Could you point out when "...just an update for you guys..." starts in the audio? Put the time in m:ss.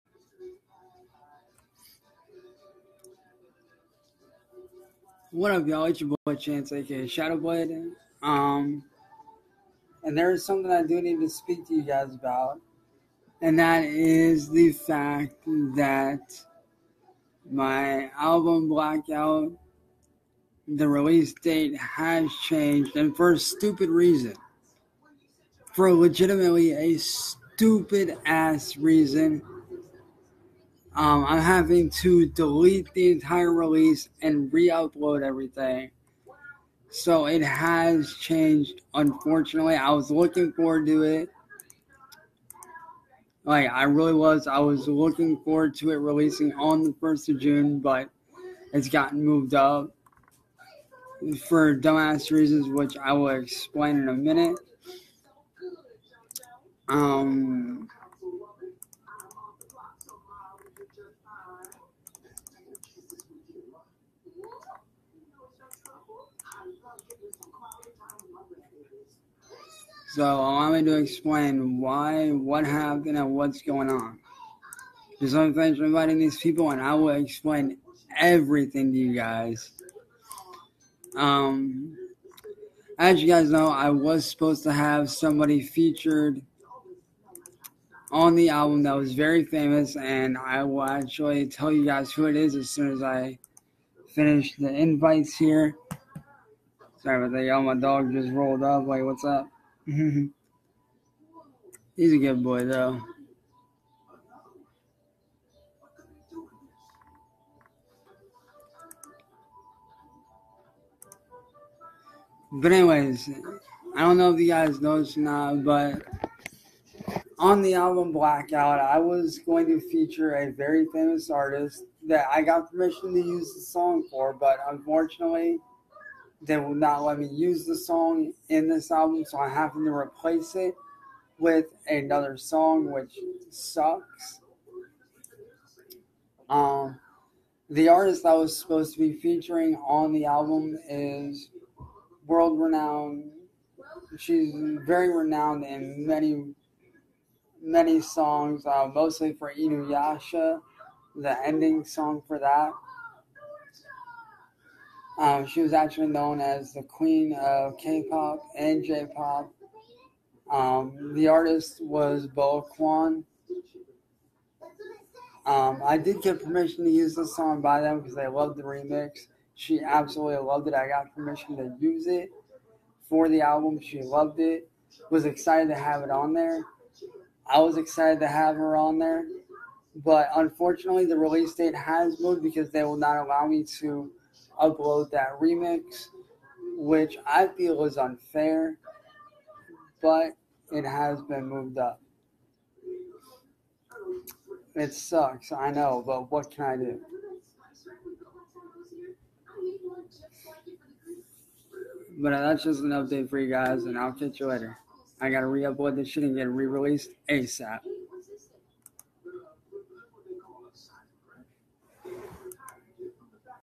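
3:22.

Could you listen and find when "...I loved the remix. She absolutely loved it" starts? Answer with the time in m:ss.
2:48.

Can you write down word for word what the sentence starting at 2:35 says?
Um, she was actually known as the queen of K-pop and J-pop.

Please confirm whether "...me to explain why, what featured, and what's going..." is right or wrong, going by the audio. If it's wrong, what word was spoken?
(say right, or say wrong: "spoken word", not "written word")
wrong: "happened", not "featured".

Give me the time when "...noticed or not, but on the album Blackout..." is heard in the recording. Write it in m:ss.
1:54.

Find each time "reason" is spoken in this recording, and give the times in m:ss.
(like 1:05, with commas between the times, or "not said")
0:23, 0:28, 0:52.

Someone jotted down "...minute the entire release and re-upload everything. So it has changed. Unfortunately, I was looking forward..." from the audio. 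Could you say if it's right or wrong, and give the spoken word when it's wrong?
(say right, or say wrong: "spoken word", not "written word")
wrong: "delete", not "minute".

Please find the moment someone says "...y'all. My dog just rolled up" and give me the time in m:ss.
1:37.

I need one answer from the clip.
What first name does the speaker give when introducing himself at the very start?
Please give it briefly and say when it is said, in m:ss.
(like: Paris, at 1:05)
Chance, at 0:06.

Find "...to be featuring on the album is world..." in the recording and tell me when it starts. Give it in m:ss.
2:18.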